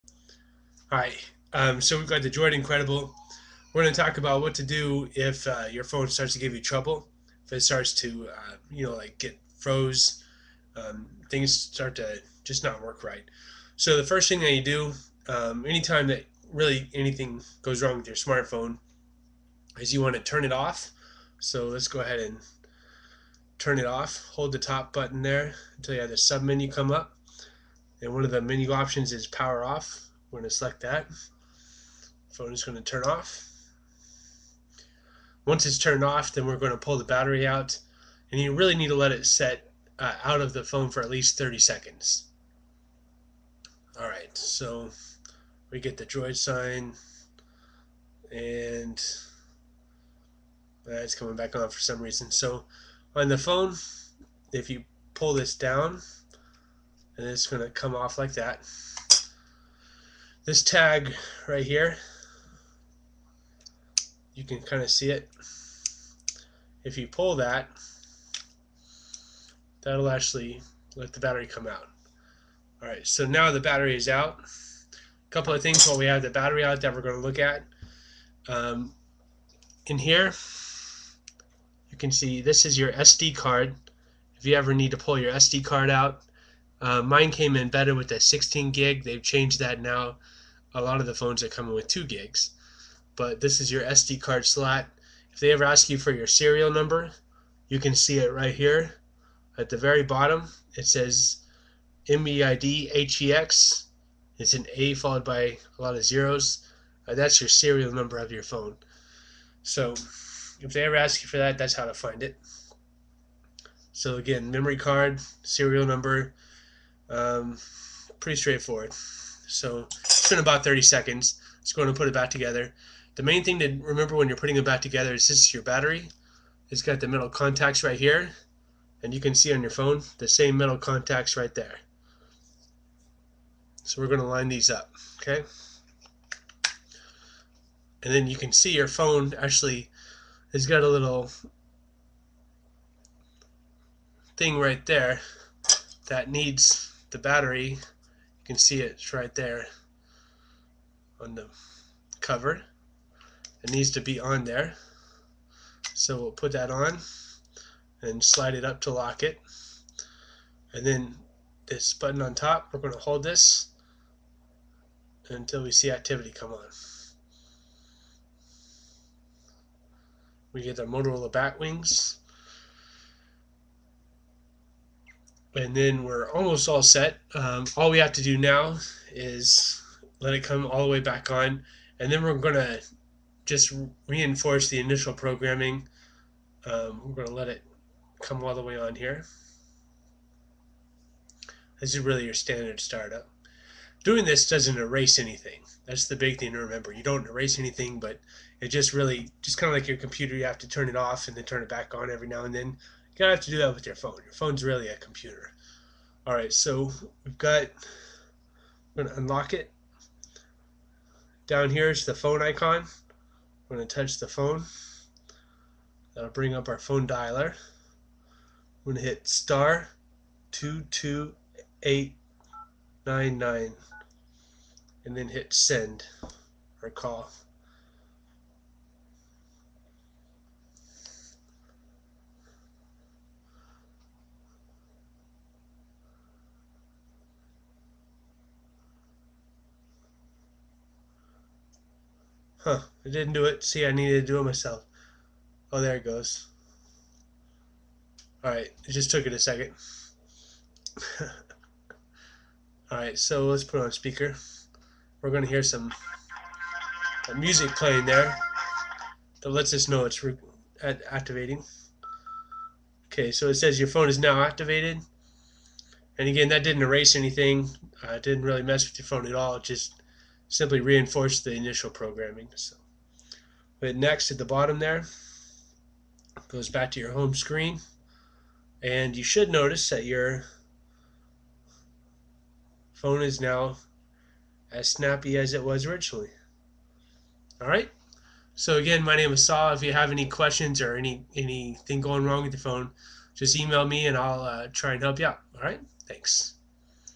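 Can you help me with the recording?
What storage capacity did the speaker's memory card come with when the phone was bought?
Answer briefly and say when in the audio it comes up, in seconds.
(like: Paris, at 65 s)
16 gig, at 88 s.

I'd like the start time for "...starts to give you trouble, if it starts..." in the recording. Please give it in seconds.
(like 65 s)
6 s.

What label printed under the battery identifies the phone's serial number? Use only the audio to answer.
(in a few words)
MEID HEX.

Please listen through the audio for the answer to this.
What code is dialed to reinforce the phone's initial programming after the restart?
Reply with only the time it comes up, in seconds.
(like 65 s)
219 s.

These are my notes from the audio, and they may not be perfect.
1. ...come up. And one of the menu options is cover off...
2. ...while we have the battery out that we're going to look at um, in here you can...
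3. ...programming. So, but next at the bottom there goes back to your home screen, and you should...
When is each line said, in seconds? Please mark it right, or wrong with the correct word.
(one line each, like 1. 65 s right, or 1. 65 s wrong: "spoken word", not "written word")
1. 26 s wrong: "power", not "cover"
2. 75 s right
3. 271 s right.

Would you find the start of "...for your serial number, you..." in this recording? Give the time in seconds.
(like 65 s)
95 s.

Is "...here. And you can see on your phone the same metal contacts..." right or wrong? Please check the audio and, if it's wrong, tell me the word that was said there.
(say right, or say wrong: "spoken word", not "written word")
right.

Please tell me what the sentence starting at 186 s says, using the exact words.
Um, we're going to let it come all the way on here.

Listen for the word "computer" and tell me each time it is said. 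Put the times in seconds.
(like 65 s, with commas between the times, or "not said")
199 s, 204 s.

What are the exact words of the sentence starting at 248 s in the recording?
Alright, it just took it a second.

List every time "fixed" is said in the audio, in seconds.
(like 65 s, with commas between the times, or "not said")
not said.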